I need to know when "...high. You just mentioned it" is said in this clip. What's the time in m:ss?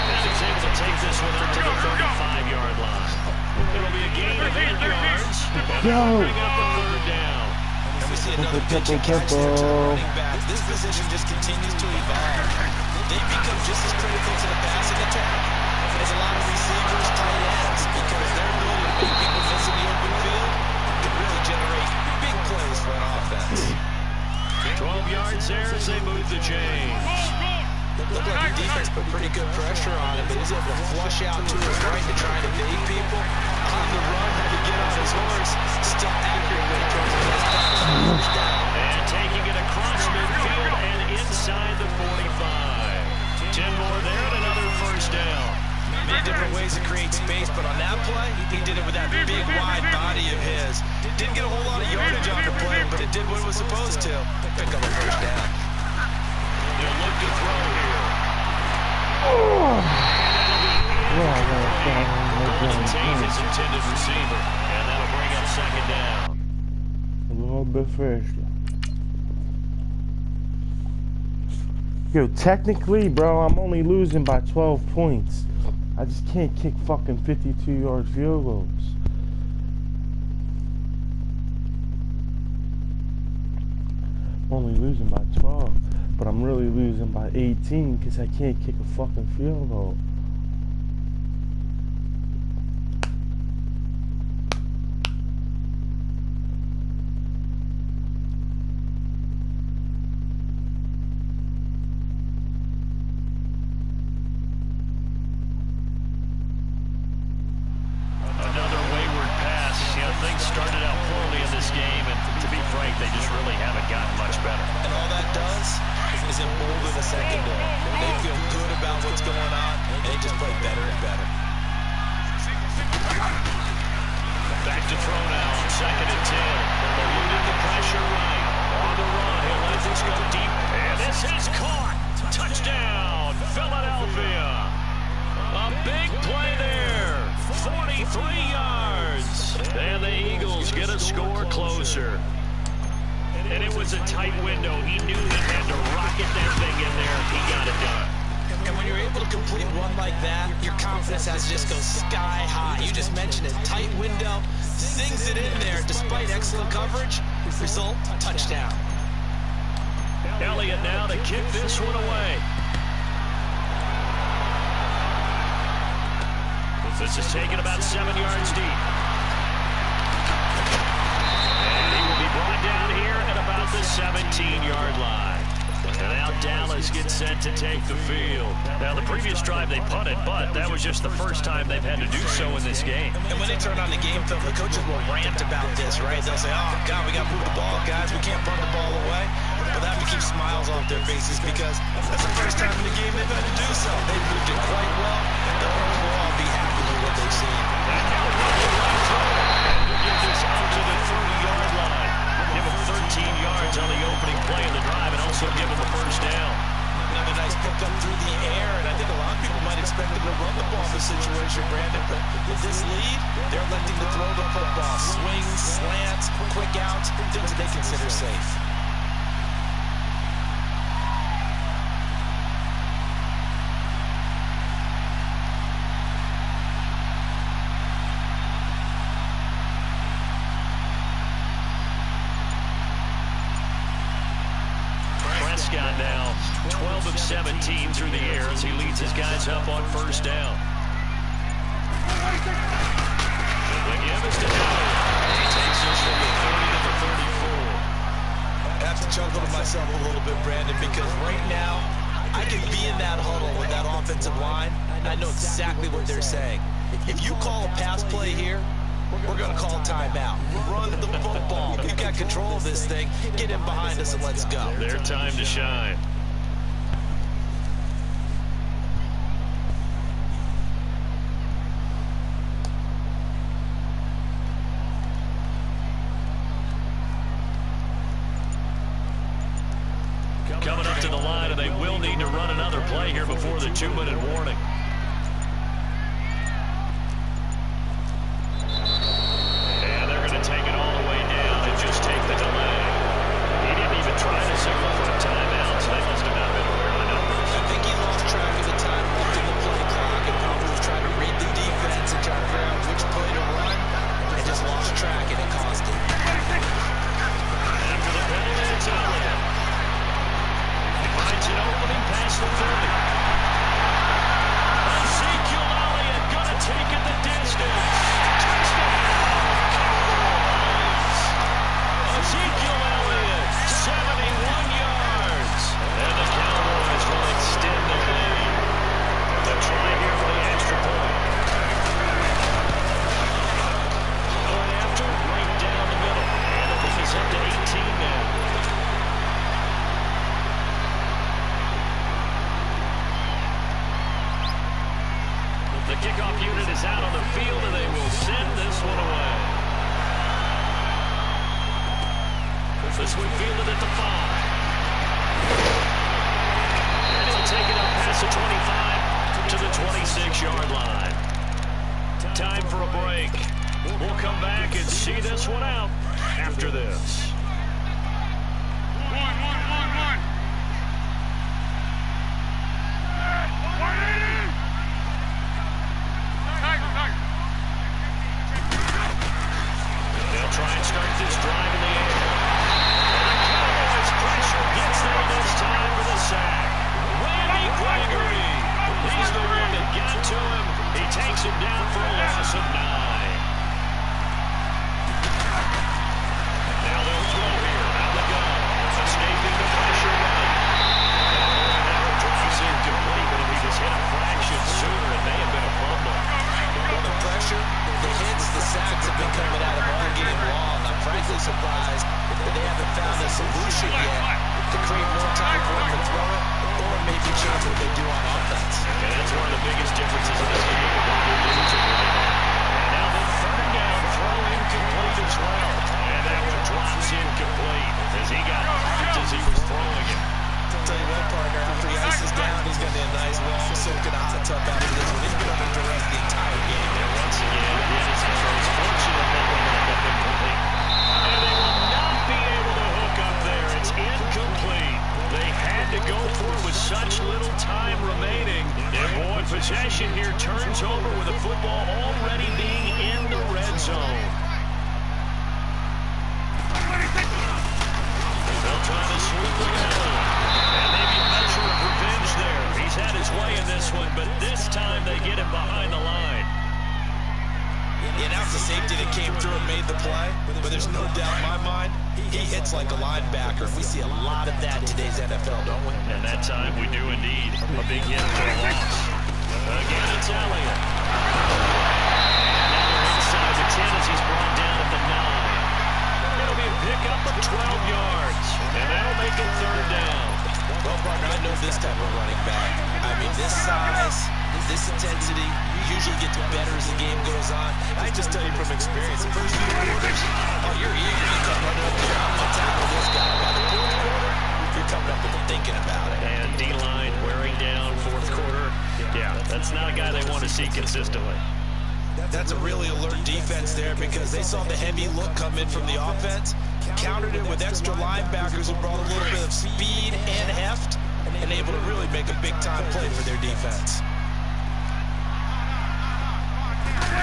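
2:32.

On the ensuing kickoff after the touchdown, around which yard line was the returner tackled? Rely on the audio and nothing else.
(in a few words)
17-yard line.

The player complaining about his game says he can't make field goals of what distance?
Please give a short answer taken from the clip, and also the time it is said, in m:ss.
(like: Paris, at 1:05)
52 yards, at 1:17.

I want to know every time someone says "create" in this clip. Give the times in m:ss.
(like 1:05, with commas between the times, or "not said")
0:46, 6:54.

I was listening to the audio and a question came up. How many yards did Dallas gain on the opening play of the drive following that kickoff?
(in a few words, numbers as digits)
13.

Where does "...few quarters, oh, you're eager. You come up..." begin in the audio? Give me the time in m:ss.
8:19.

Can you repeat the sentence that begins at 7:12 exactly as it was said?
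He's going to be a nice long soaking in a hot tub after this one.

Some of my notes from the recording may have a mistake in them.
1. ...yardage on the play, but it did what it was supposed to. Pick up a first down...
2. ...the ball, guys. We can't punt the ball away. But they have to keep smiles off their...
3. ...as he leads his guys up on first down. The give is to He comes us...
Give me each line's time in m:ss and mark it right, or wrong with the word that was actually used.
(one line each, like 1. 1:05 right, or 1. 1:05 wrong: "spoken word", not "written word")
1. 0:51 right
2. 3:07 right
3. 3:58 wrong: "takes", not "comes".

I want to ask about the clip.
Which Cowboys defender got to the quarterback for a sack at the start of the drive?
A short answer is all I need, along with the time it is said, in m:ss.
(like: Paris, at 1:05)
Randy Gregory, at 6:27.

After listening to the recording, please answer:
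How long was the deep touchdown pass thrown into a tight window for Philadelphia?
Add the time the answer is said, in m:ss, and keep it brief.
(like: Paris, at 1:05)
43 yards, at 2:17.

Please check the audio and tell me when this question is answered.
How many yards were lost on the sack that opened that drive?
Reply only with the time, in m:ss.
6:32.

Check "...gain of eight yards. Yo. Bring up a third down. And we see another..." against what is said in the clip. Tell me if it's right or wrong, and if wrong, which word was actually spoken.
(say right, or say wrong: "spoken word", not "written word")
right.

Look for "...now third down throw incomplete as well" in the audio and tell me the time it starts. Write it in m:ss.
7:02.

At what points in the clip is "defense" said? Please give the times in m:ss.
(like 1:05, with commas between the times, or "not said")
0:28, 8:33, 8:43.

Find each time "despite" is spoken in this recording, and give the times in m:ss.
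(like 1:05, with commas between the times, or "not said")
2:35.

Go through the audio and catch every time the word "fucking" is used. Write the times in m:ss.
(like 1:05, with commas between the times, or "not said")
1:16, 1:28.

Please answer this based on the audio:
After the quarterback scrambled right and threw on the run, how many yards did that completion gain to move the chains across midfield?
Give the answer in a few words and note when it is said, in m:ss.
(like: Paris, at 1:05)
10, at 0:43.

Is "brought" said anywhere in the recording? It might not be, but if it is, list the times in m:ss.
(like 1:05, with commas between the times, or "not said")
2:52, 8:04, 8:38.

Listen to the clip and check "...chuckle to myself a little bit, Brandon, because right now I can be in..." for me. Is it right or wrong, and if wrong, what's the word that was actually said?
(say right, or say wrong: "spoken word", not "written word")
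right.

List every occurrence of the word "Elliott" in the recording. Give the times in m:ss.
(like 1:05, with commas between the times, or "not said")
2:40, 8:00.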